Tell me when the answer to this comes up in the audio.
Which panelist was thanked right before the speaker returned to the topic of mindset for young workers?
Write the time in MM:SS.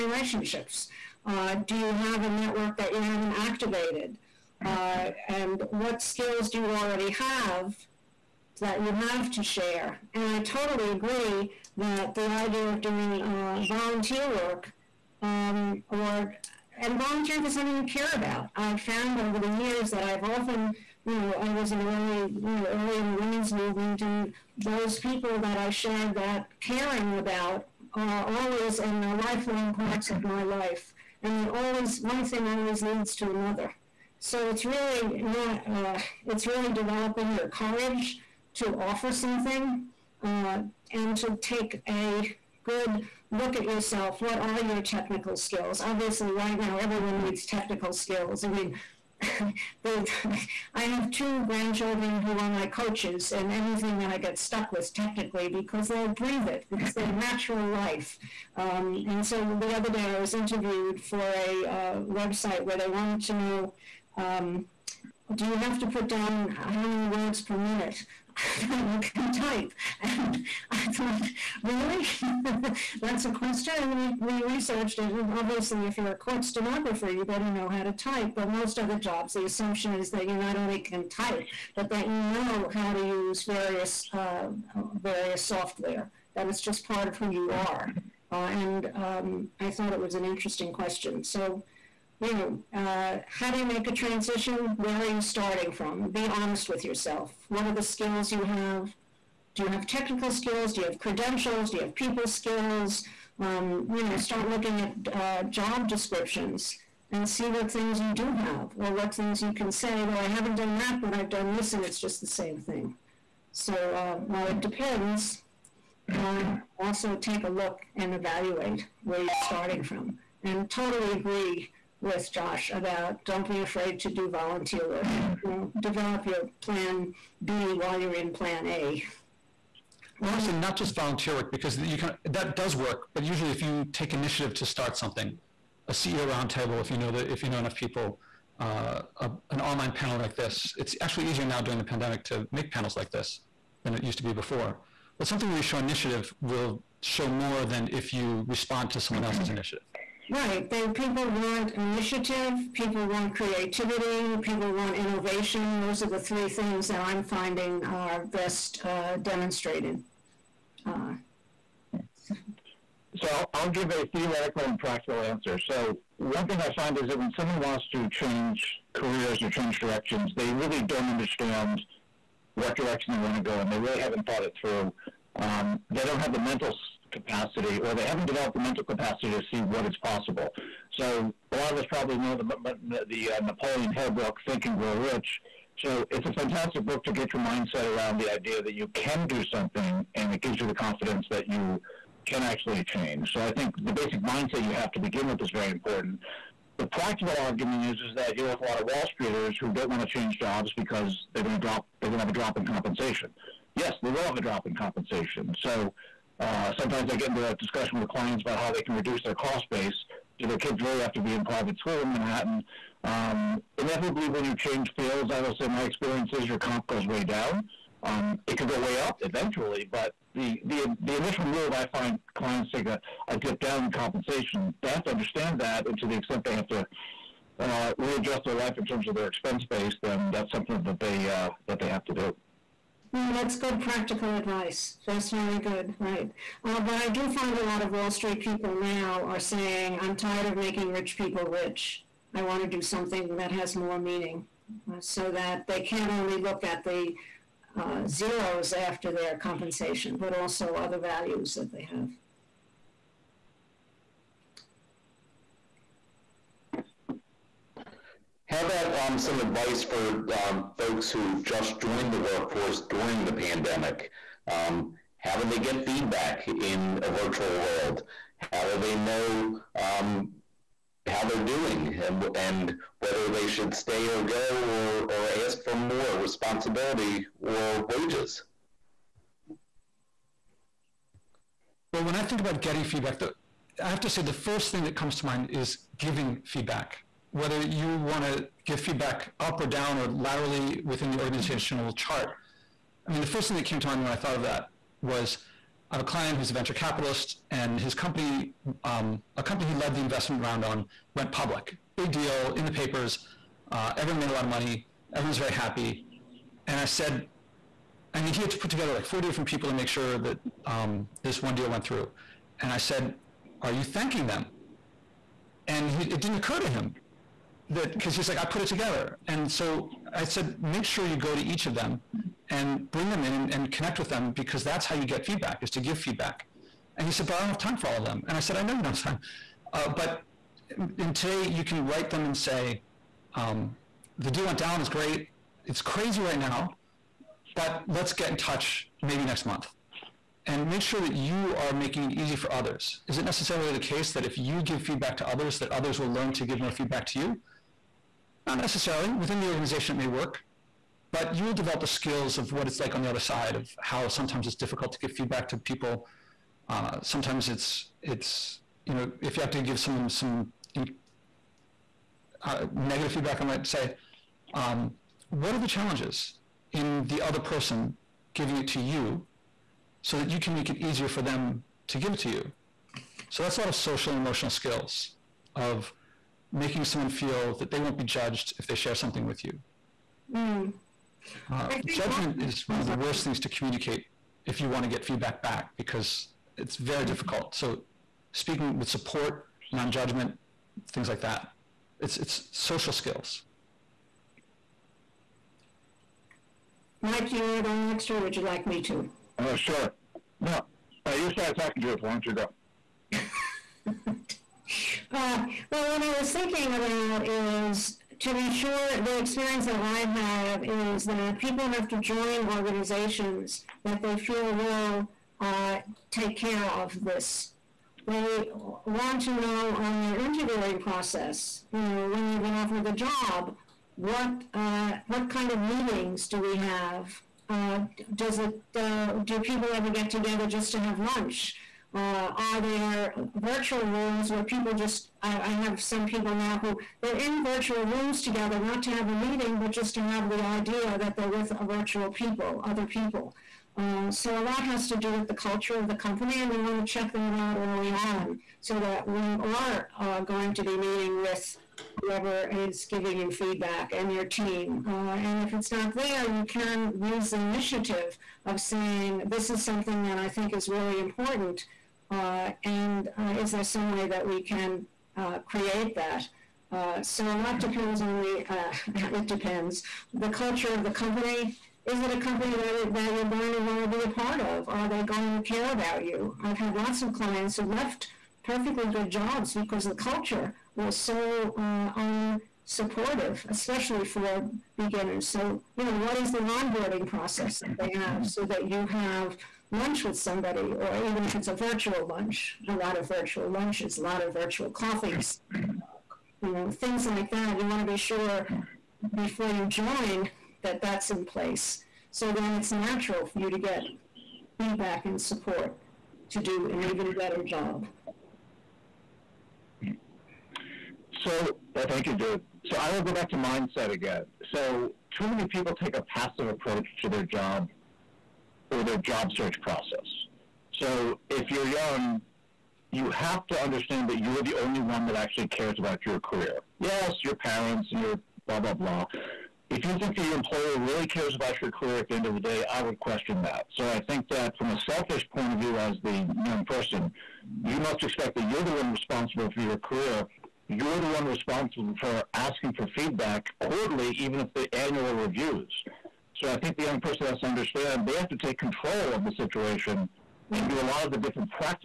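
08:32.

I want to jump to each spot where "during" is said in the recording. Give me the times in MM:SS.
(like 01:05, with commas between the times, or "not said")
02:21, 04:22.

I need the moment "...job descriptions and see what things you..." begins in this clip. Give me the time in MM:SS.
01:45.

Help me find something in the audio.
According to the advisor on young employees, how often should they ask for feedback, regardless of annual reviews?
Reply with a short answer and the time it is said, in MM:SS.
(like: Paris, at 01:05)
quarterly, at 09:03.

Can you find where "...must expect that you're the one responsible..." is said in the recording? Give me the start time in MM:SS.
08:57.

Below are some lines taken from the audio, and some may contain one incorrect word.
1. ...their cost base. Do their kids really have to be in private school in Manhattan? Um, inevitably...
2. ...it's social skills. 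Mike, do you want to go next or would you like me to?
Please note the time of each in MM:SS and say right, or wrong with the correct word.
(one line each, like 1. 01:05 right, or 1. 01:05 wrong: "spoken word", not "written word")
1. 03:29 right
2. 06:32 right.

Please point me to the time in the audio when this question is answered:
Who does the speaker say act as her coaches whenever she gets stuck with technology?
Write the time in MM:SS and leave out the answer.
00:51.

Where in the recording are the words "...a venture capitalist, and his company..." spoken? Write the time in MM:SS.
04:56.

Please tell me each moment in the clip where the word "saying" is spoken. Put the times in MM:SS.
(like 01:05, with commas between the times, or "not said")
03:59, 07:38.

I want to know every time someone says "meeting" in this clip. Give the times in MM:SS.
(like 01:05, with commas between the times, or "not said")
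07:05, 07:19, 07:30.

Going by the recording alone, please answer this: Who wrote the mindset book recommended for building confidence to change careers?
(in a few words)
Napoleon Hill.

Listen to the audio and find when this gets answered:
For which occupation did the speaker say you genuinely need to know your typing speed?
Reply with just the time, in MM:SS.
01:16.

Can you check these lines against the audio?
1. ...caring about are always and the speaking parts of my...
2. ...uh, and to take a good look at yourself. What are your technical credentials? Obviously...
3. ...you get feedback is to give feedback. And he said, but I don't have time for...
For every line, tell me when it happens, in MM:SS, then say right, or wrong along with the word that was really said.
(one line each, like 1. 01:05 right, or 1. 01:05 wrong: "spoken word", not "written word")
1. 00:26 wrong: "lifelong", not "speaking"
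2. 00:40 wrong: "skills", not "credentials"
3. 05:24 right.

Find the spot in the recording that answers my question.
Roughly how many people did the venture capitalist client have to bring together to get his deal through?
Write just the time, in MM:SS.
05:09.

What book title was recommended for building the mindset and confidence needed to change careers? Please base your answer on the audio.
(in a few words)
Think and Grow Rich.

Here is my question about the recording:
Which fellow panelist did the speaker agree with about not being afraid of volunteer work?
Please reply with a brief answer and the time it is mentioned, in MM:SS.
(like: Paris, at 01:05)
Josh, at 02:02.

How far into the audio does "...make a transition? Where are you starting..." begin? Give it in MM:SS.
01:33.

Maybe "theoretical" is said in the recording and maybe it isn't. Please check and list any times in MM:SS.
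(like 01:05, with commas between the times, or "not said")
02:44.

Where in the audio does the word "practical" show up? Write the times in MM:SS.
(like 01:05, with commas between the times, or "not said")
02:44, 03:16, 03:53.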